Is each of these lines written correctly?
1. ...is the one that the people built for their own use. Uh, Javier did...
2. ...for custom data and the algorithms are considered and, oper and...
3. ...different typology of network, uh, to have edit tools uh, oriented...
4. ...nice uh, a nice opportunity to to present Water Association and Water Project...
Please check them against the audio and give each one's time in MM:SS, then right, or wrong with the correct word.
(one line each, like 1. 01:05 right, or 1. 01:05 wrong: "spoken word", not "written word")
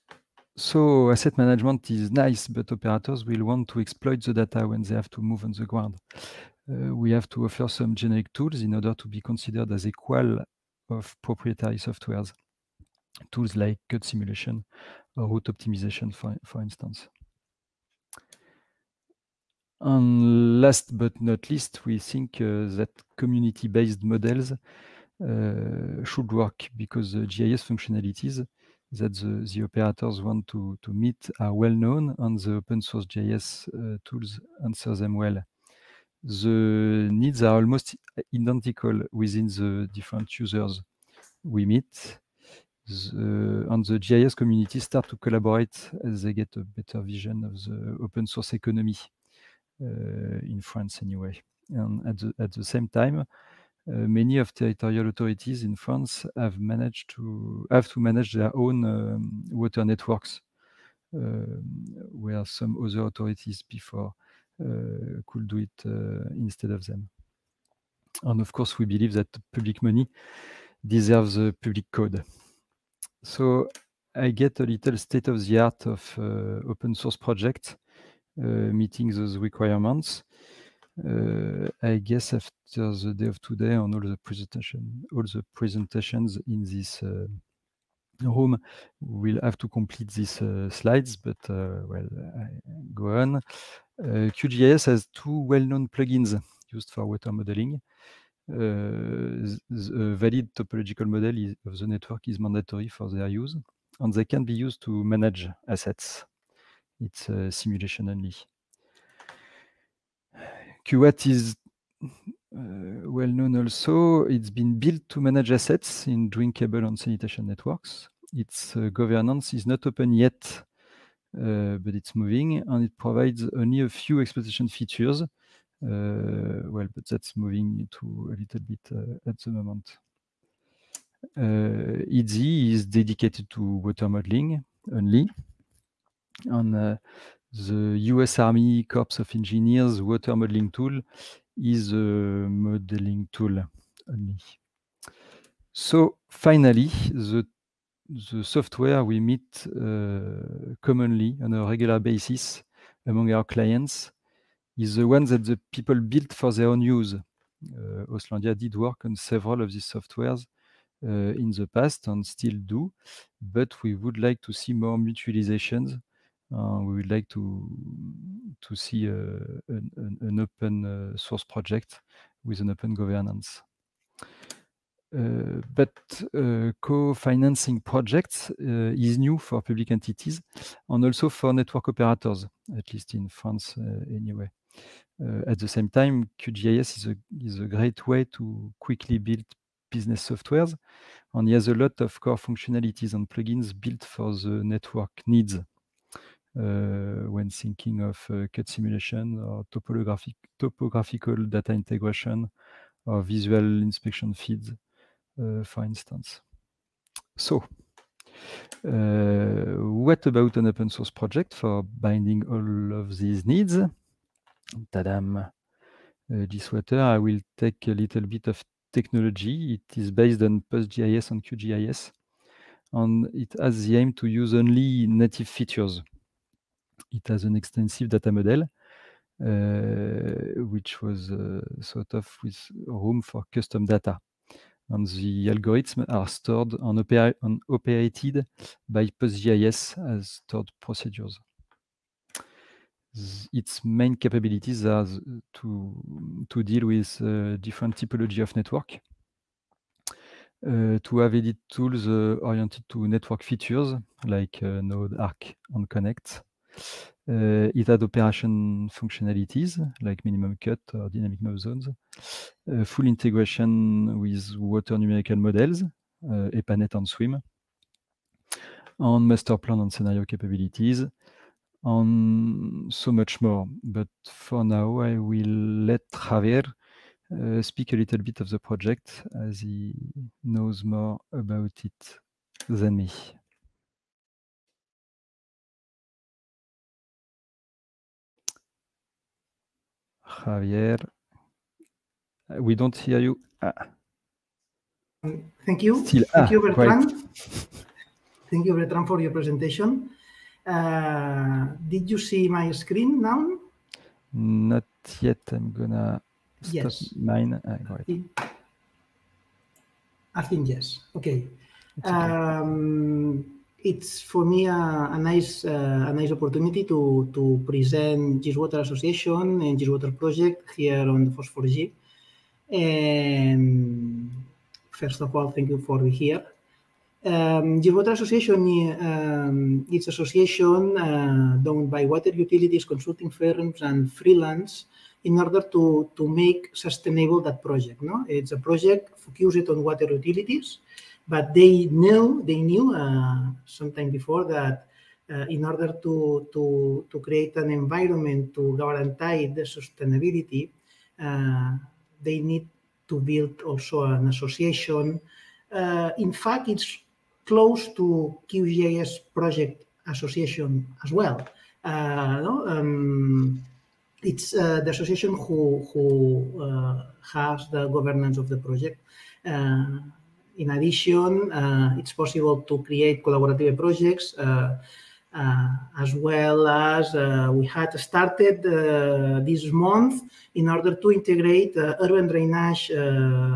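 1. 02:34 wrong: "Oslandia", not "Javier"
2. 03:53 wrong: "stored", not "considered"
3. 04:07 right
4. 05:15 right.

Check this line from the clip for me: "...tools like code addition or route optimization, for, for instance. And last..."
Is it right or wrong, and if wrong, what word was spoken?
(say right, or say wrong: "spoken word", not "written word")
wrong: "simulation", not "addition".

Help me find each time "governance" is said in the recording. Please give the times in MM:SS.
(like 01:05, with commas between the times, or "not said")
01:58, 02:52, 06:07.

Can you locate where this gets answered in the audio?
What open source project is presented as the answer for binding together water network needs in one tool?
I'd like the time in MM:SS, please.
03:36.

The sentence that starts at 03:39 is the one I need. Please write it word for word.
It is based on PostGIS and QGIS, and it has the aim to use only native features.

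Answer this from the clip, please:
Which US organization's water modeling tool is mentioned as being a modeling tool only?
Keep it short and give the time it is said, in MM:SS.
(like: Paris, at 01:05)
US Army Corps of Engineers, at 02:18.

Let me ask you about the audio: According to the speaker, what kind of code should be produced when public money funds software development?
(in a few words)
A public code.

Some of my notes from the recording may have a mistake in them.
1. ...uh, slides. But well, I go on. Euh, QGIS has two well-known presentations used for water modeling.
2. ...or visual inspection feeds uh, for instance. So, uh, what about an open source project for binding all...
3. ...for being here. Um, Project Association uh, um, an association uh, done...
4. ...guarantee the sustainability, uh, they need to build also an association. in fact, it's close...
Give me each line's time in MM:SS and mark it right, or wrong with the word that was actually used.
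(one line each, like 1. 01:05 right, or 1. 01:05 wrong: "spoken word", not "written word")
1. 01:30 wrong: "plugins", not "presentations"
2. 03:23 right
3. 05:25 wrong: "Water", not "Project"
4. 05:48 right.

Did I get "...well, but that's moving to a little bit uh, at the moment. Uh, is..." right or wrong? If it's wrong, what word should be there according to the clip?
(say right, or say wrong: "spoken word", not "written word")
right.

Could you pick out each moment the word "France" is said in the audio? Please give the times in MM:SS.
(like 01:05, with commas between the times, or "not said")
00:50, 00:55, 03:03.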